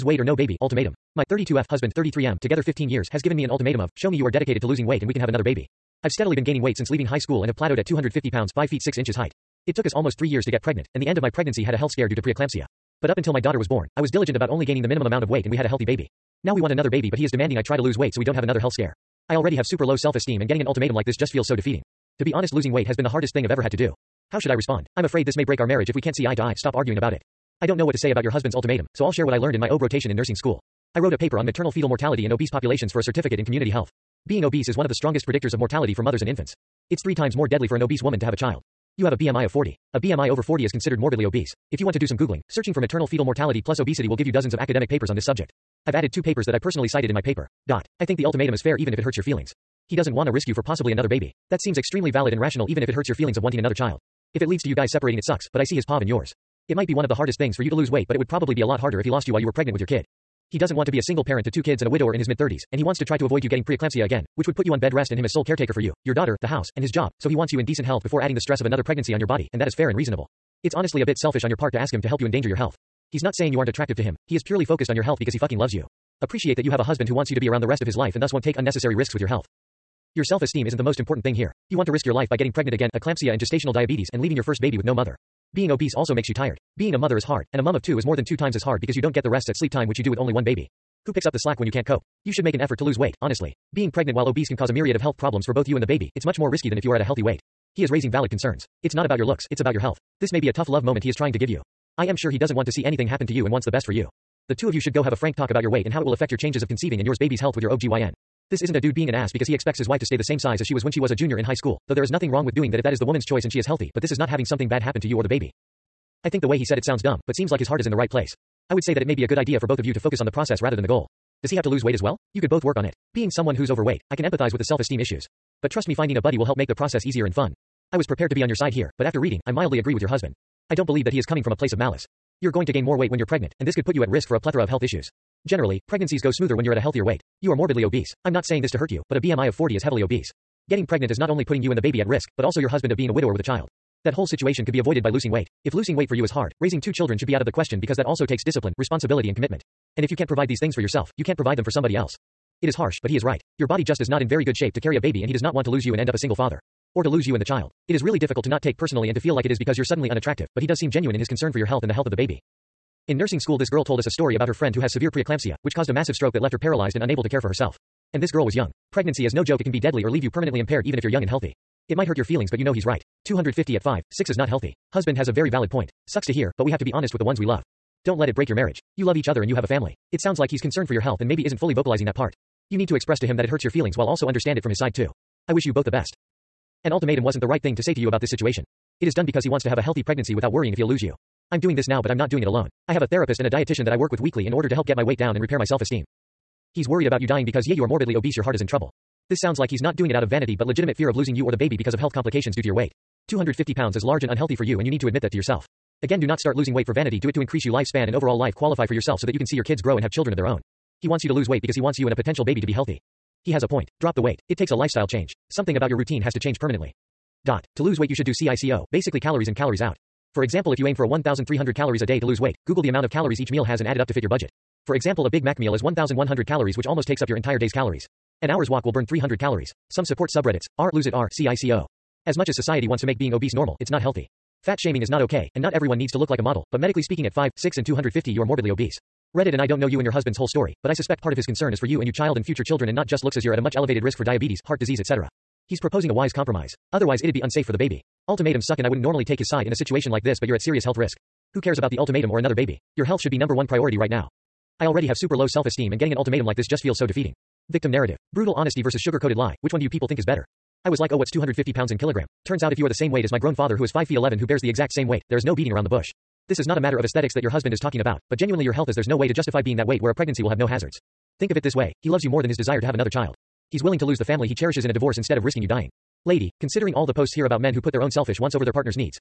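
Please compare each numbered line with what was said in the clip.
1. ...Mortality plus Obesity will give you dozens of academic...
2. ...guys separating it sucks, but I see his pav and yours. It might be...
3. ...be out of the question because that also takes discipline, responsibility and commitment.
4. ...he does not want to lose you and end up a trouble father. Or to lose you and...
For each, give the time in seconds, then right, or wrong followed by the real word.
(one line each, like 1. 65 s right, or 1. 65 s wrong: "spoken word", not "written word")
1. 43 s right
2. 54 s right
3. 147 s right
4. 155 s wrong: "single", not "trouble".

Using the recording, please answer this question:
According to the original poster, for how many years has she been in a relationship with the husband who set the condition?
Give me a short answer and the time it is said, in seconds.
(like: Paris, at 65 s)
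15 years, at 2 s.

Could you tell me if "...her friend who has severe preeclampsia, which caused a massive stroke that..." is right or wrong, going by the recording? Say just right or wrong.
right.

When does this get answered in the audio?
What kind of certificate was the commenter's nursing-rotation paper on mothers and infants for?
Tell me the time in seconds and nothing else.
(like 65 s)
33 s.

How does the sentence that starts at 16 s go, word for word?
Now we want another baby but he is demanding I try to lose weight so we don't have another health scare.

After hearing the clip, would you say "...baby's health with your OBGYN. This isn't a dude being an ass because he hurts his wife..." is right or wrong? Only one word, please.
wrong.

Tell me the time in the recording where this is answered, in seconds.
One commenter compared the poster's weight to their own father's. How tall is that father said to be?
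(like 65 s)
263 s.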